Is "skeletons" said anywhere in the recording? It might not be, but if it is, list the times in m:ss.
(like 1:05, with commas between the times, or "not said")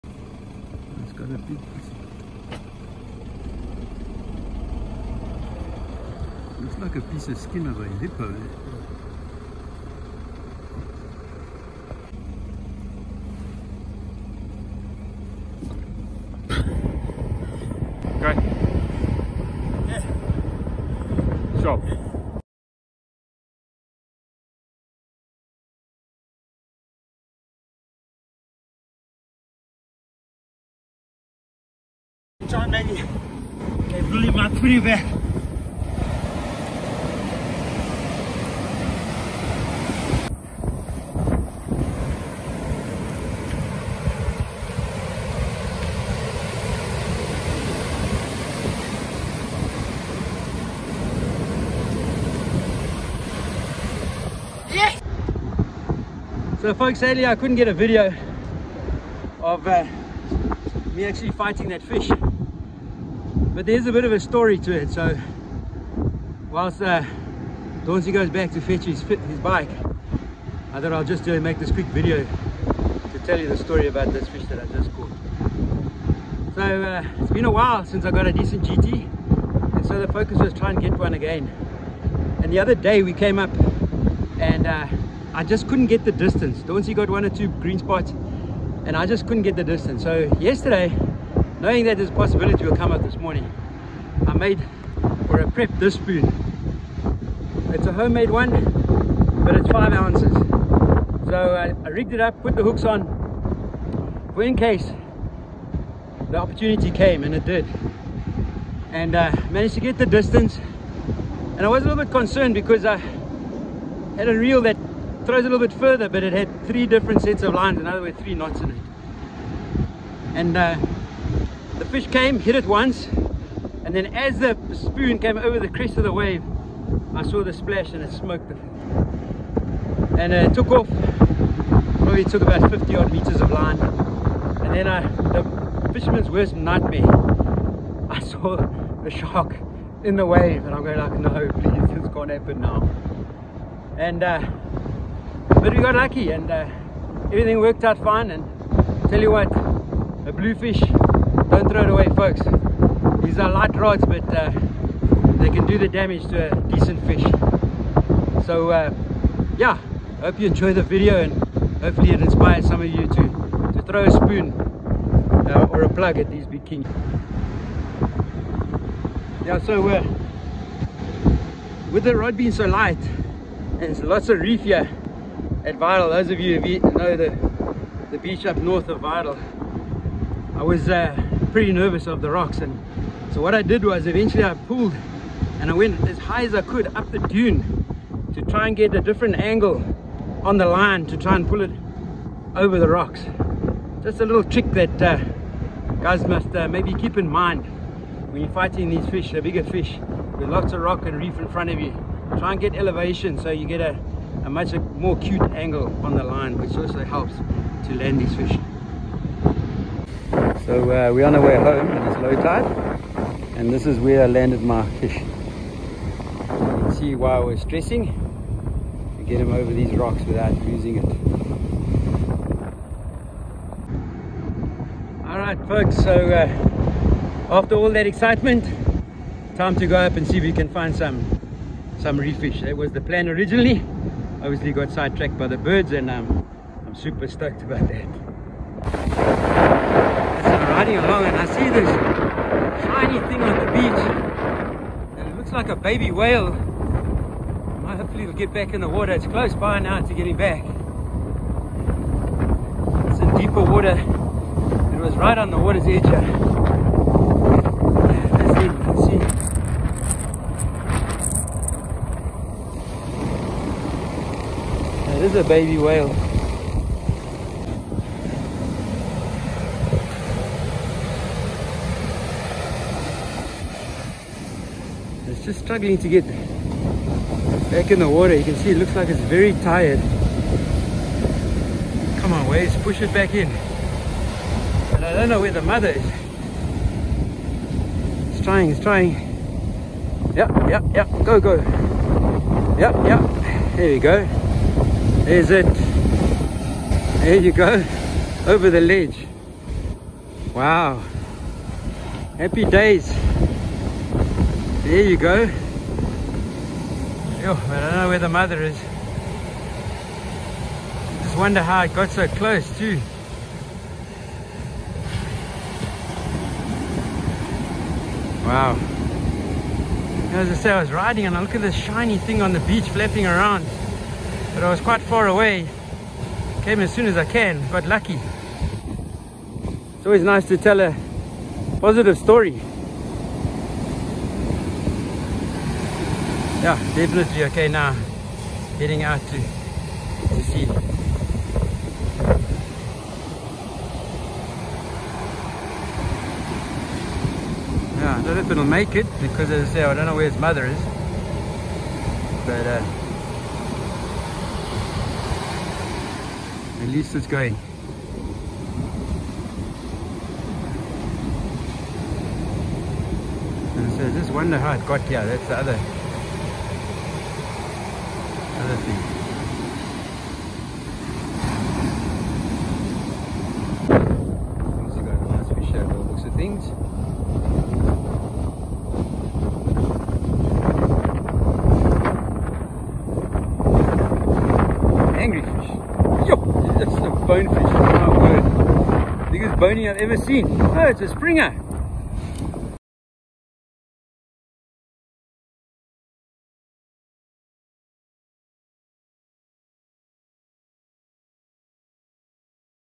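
not said.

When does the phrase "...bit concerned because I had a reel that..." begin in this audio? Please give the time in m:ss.
1:52.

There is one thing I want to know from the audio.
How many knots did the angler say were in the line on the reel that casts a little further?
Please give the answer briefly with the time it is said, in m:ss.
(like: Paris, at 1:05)
3, at 1:58.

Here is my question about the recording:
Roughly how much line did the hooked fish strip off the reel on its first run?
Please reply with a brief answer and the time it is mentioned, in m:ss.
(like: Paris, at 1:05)
50 meters, at 2:12.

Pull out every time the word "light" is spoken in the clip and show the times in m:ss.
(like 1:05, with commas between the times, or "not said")
2:33, 2:52.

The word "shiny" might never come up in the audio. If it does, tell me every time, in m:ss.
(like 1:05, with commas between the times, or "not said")
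4:02, 5:21.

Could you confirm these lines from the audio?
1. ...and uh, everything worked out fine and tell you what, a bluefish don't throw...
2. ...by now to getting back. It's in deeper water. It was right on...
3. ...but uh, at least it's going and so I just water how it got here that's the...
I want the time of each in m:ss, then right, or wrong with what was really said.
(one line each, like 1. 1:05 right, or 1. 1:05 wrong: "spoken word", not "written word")
1. 2:26 right
2. 4:09 right
3. 5:52 wrong: "wonder", not "water".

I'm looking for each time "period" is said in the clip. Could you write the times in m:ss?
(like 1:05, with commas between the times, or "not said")
not said.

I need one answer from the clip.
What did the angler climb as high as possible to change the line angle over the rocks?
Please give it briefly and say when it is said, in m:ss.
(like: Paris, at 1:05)
The dune, at 3:07.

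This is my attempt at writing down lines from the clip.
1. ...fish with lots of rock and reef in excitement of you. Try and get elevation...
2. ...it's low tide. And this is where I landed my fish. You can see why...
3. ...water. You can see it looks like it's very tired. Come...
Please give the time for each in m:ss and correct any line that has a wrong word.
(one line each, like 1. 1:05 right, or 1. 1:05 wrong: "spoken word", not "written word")
1. 3:19 wrong: "front", not "excitement"
2. 3:32 right
3. 4:38 right.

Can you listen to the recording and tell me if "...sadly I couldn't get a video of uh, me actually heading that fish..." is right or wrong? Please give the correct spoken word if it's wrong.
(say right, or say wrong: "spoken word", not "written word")
wrong: "fighting", not "heading".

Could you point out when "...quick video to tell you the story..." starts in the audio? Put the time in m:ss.
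1:11.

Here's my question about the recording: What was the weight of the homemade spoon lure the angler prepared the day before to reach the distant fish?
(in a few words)
5 ounces.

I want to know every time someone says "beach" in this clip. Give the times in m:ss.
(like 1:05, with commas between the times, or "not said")
2:58, 4:03, 5:22.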